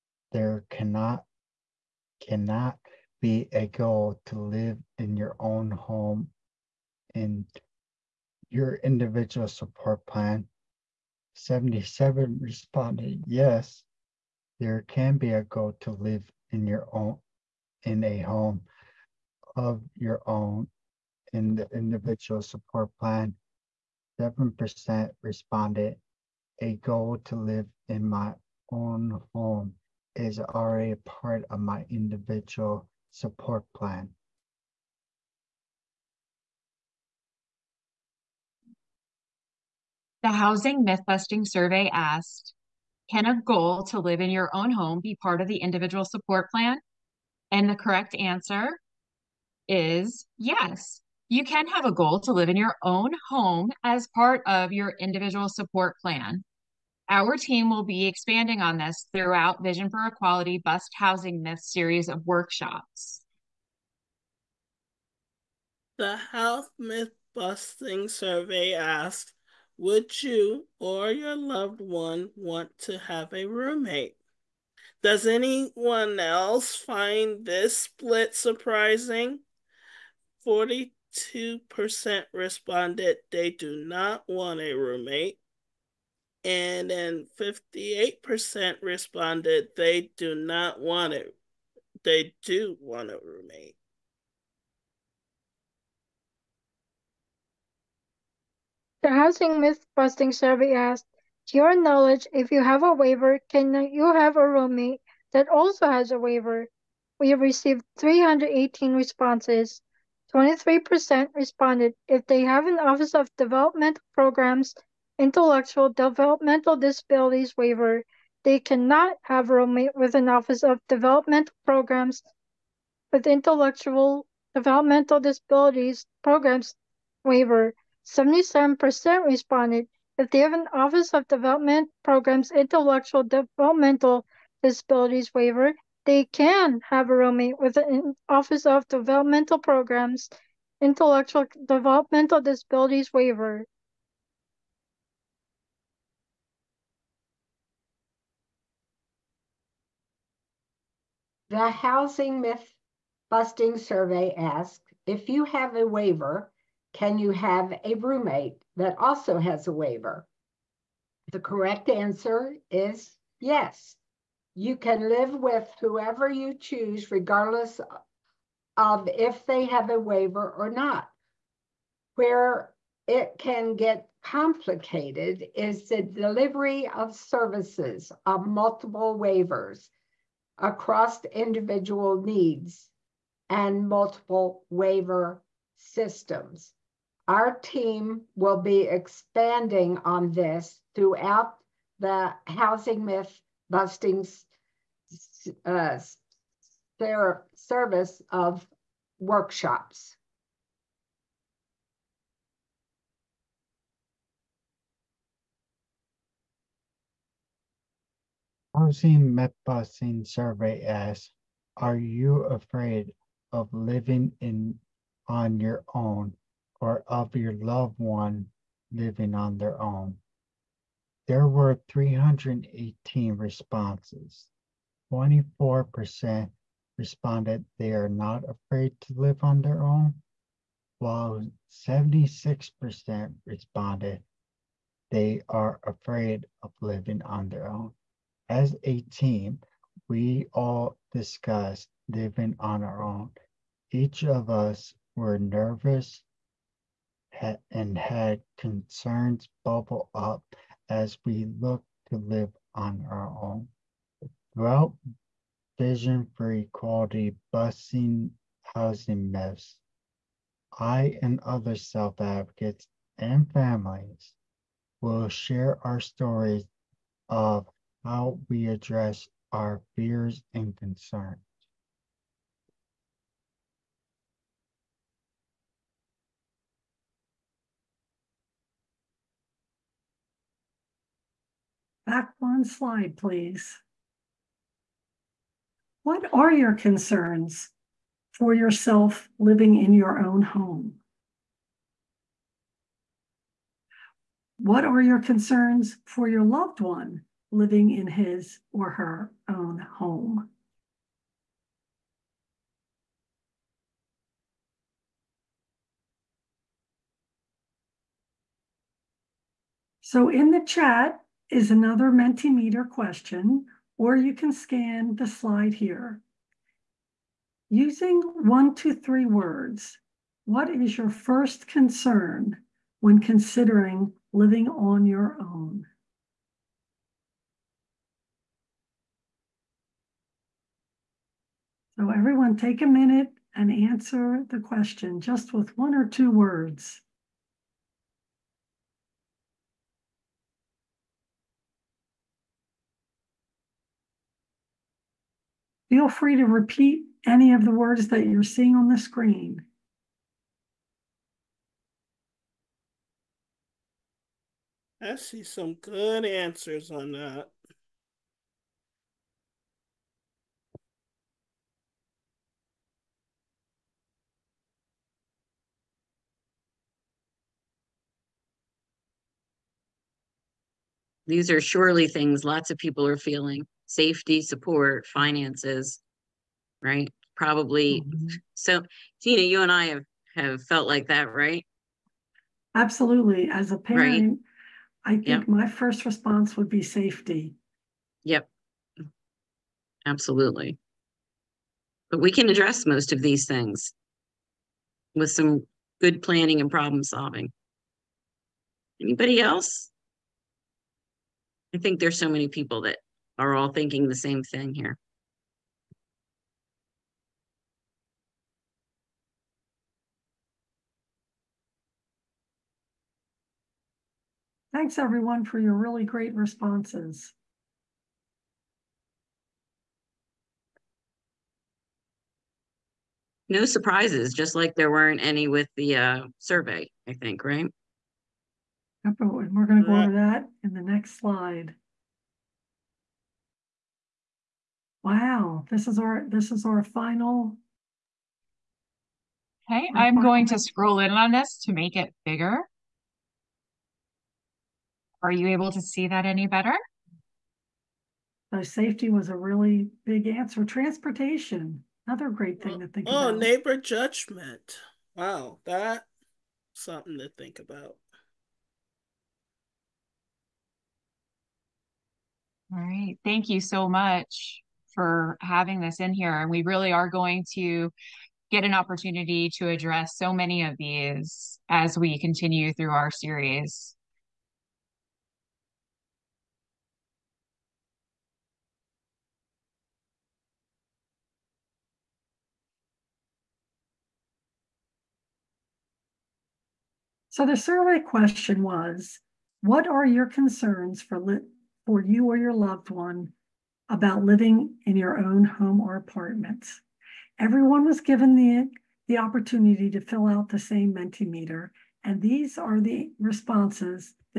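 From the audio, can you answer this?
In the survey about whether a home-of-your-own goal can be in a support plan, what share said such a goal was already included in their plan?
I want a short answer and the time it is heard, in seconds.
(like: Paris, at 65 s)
7%, at 24 s.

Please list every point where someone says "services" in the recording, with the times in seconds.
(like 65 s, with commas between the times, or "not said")
177 s, 197 s.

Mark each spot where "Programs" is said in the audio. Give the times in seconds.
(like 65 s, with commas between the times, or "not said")
114 s, 121 s, 126 s, 132 s, 139 s.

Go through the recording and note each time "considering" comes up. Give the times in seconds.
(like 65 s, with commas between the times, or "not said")
323 s.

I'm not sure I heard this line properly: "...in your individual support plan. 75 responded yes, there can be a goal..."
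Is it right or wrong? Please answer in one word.
wrong.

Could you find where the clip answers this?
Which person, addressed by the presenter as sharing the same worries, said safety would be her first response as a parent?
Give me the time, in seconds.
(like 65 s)
379 s.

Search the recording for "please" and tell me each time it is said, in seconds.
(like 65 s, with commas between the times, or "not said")
283 s.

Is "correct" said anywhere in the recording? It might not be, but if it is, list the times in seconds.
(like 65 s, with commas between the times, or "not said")
47 s, 161 s.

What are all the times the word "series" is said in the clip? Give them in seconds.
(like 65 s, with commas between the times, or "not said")
61 s, 473 s.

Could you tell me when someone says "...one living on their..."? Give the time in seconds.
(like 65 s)
217 s.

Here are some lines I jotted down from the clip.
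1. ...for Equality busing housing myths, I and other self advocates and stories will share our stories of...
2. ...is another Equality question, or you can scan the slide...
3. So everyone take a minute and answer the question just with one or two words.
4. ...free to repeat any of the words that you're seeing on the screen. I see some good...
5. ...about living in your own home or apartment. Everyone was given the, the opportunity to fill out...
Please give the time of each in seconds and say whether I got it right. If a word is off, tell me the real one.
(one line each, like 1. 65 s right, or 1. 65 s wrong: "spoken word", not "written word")
1. 256 s wrong: "families", not "stories"
2. 311 s wrong: "Mentimeter", not "Equality"
3. 331 s right
4. 346 s right
5. 493 s right.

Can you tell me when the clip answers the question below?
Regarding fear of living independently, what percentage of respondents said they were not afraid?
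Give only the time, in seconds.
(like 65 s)
225 s.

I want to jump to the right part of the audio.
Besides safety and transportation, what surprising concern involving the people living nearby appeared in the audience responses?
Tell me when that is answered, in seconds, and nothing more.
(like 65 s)
453 s.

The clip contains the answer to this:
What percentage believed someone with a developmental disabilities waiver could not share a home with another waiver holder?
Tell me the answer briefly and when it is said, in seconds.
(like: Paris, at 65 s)
23%, at 110 s.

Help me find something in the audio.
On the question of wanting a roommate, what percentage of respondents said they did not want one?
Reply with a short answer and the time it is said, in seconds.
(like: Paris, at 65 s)
42%, at 80 s.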